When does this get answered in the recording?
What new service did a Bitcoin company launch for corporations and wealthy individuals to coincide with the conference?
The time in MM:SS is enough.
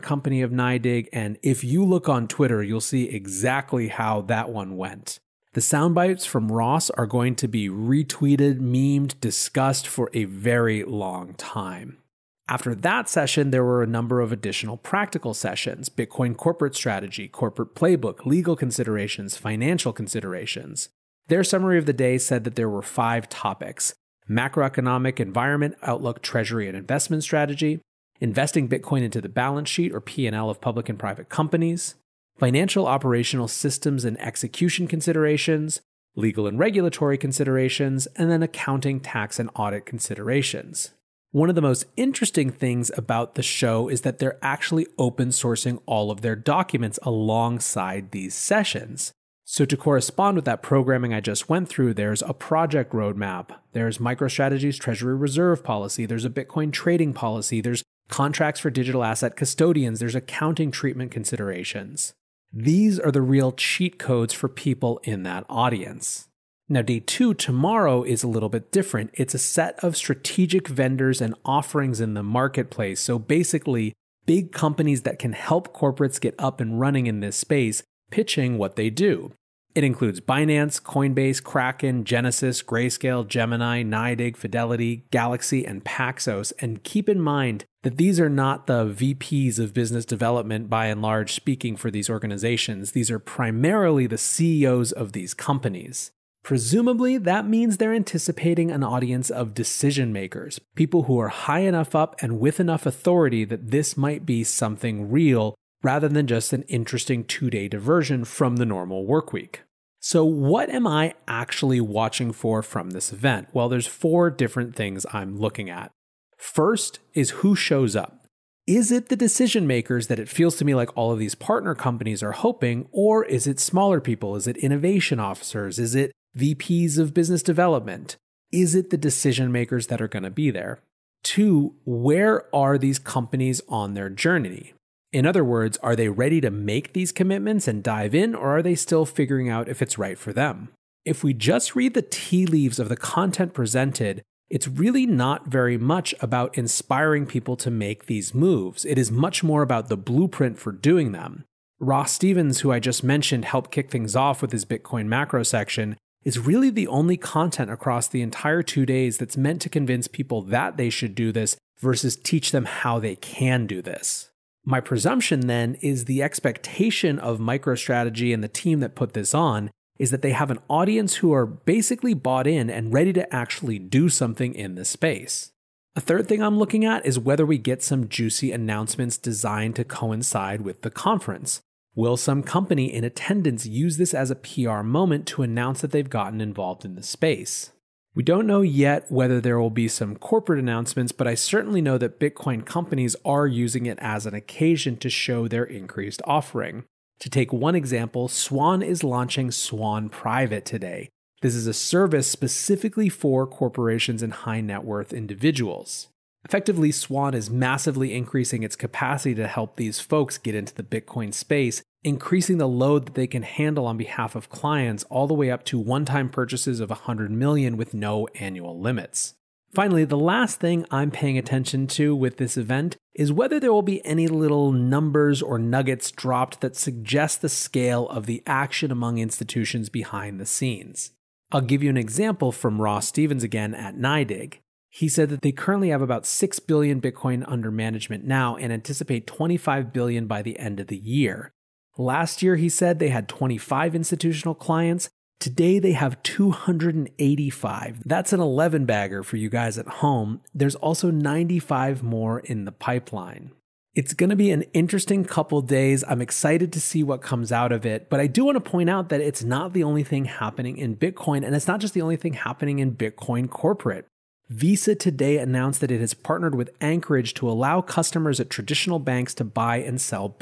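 03:19.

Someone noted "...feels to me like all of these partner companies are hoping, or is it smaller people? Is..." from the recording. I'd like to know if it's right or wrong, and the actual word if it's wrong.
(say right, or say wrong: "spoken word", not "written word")
right.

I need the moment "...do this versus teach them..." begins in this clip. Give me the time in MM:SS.
02:41.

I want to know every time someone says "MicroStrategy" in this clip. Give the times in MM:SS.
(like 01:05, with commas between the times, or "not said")
00:53, 02:47.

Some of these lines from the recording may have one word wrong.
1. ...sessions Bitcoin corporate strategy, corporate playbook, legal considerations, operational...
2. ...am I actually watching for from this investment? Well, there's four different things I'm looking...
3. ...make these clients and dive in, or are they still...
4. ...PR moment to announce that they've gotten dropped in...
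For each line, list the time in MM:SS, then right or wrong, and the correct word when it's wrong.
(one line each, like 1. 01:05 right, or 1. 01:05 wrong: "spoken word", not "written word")
1. 00:15 wrong: "financial", not "operational"
2. 01:50 wrong: "event", not "investment"
3. 02:16 wrong: "commitments", not "clients"
4. 03:04 wrong: "involved", not "dropped".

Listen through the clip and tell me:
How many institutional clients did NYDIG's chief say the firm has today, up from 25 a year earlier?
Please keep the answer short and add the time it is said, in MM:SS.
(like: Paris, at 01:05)
285, at 04:06.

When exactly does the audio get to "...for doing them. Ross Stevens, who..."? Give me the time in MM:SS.
02:30.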